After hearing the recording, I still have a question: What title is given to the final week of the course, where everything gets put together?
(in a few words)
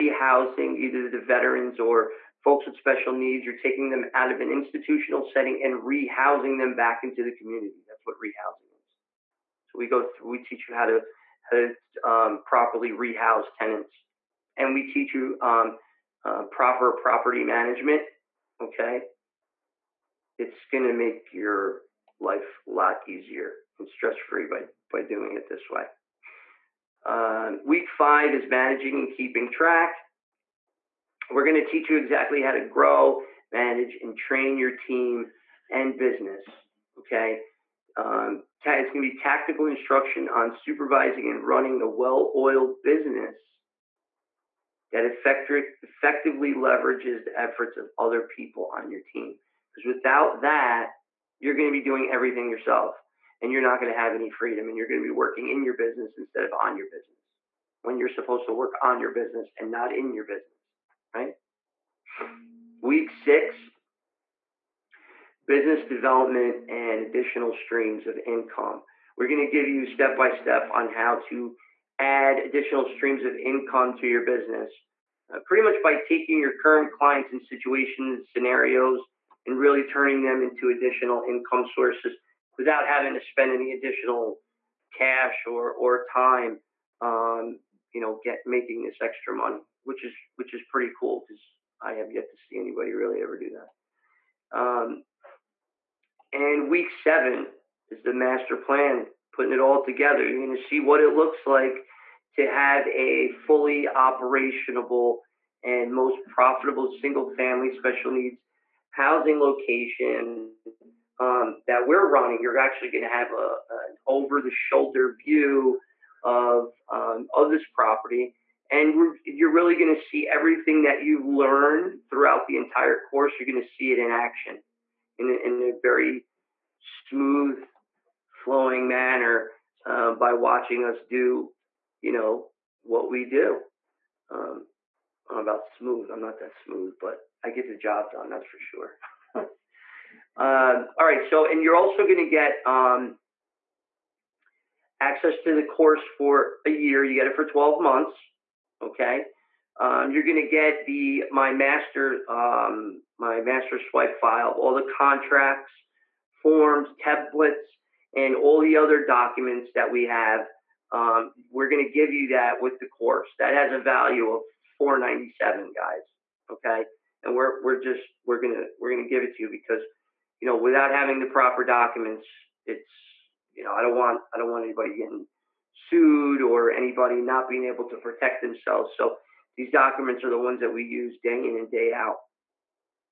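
The master plan.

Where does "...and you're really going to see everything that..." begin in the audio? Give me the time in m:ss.
1:58.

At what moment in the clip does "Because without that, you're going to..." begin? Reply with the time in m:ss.
0:49.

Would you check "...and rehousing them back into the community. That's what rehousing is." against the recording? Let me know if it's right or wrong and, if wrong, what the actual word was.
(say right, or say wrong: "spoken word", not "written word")
right.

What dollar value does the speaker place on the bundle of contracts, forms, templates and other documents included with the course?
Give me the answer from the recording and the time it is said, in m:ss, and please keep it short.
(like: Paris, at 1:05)
$497, at 2:44.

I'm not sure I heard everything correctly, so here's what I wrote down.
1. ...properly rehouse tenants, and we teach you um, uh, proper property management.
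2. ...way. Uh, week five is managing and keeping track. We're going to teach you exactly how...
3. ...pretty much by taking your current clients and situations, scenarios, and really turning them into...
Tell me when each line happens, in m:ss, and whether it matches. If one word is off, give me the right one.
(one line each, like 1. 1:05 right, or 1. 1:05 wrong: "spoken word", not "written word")
1. 0:12 right
2. 0:25 right
3. 1:15 right.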